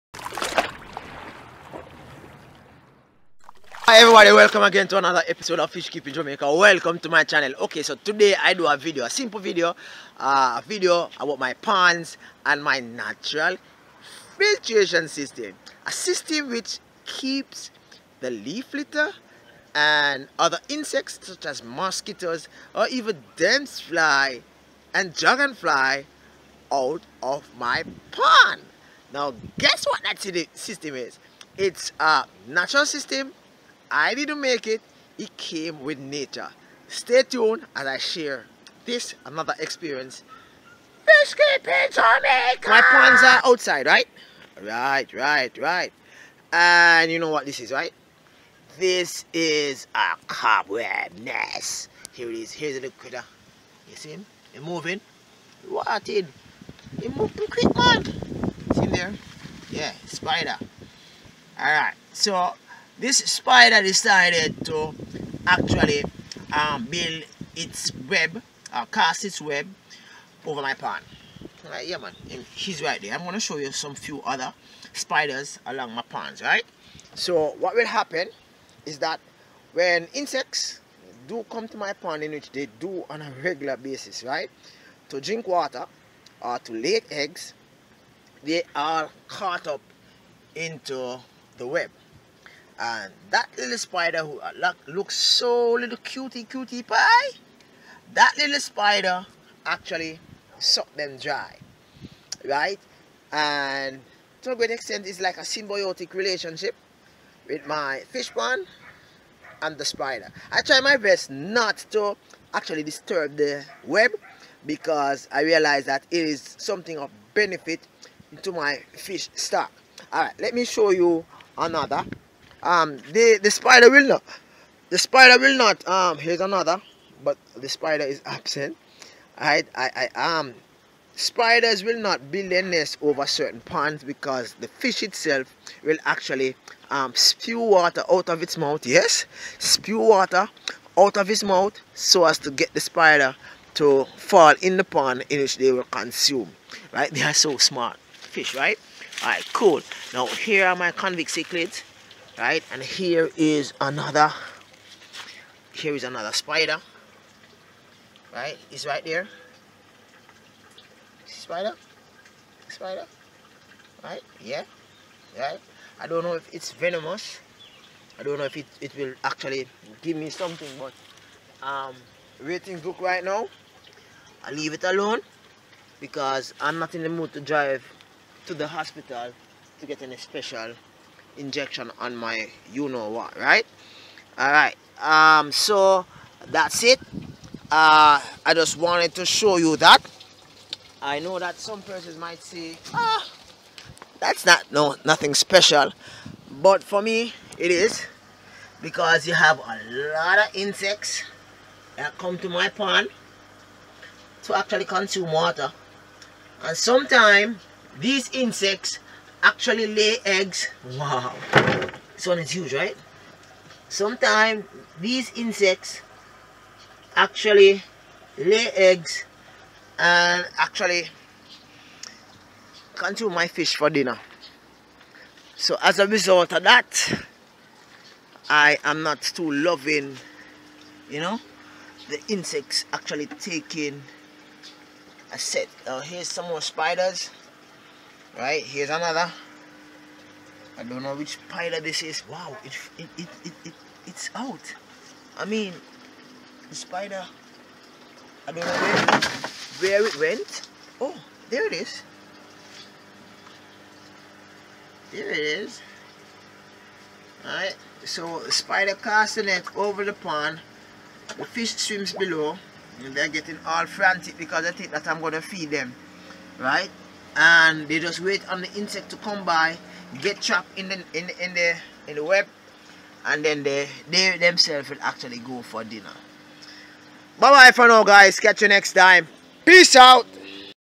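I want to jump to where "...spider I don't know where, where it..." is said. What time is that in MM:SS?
04:06.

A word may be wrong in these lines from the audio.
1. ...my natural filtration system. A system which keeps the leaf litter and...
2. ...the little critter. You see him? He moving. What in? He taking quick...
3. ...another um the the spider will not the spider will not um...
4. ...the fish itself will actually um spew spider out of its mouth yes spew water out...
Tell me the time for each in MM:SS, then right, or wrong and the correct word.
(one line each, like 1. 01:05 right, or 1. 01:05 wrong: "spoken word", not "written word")
1. 00:12 right
2. 00:52 wrong: "moving", not "taking"
3. 02:01 right
4. 02:14 wrong: "water", not "spider".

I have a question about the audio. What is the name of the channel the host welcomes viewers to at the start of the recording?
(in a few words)
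Fish Keeping Jamaica.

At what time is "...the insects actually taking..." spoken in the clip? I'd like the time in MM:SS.
03:52.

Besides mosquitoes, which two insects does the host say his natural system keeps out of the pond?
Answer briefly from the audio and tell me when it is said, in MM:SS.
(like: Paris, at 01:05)
Damselfly and dragonfly, at 00:23.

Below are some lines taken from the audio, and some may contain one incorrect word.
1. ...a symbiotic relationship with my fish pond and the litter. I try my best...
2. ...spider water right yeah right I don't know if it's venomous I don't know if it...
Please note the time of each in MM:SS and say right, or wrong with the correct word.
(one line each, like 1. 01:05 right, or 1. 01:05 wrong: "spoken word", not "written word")
1. 01:45 wrong: "spider", not "litter"
2. 02:41 wrong: "spider", not "water".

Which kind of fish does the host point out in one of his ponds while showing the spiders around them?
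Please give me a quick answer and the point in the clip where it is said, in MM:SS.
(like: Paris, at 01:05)
Convict cichlids, at 02:30.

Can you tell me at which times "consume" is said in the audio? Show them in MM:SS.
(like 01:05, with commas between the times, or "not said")
02:25, 03:24, 03:42.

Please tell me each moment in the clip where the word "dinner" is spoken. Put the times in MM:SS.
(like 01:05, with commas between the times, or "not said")
03:43, 04:35.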